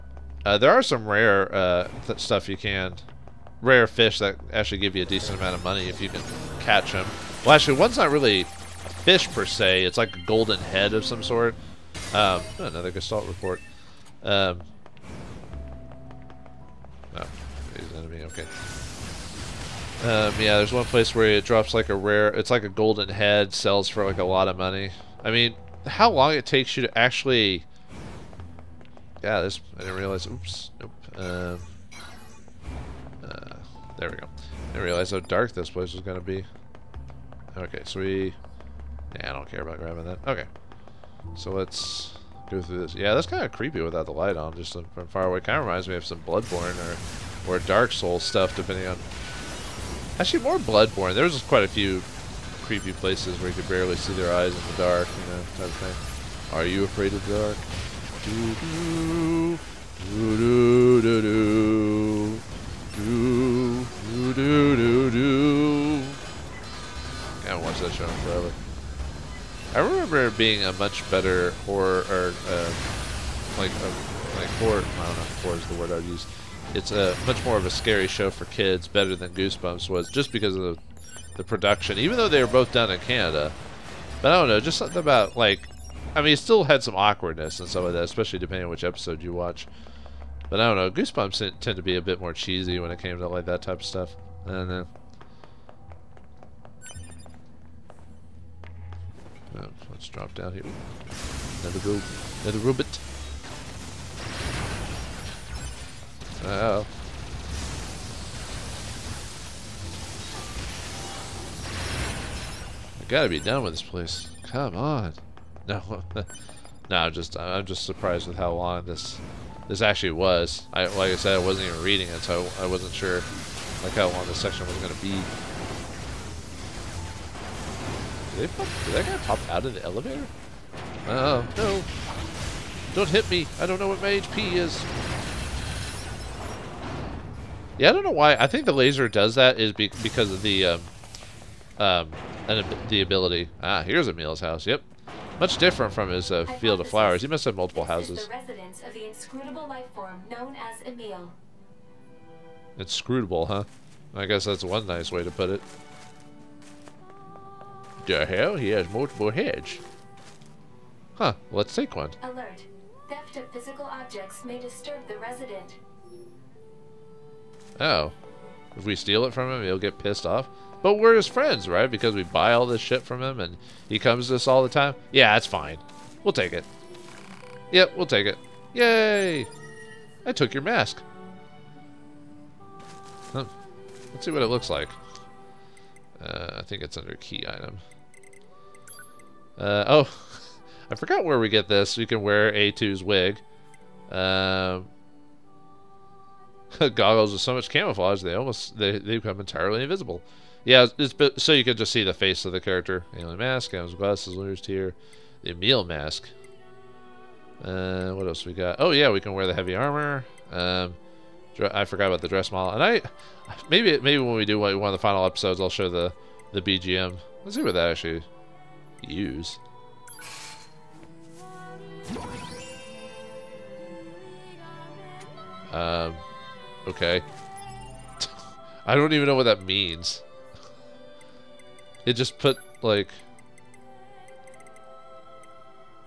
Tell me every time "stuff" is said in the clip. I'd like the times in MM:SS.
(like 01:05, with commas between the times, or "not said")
00:02, 00:48, 01:33.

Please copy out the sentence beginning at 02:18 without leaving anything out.
I think the laser does that is be because of the um, um, the ability.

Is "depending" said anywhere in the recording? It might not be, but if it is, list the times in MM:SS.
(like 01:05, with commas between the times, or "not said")
00:48, 01:28.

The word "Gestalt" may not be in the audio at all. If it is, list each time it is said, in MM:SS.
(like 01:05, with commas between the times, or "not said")
00:12.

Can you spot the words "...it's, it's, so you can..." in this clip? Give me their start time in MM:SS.
03:20.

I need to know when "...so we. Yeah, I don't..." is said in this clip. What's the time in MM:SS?
00:37.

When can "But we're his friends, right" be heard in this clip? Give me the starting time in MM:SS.
02:50.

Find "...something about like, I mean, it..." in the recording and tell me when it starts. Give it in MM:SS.
01:24.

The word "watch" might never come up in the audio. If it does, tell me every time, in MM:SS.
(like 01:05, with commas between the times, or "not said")
01:07, 01:29.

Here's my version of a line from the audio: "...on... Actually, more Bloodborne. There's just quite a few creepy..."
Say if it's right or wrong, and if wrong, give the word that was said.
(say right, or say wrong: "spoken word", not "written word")
right.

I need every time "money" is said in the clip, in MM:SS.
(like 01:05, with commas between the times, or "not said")
00:05, 00:24.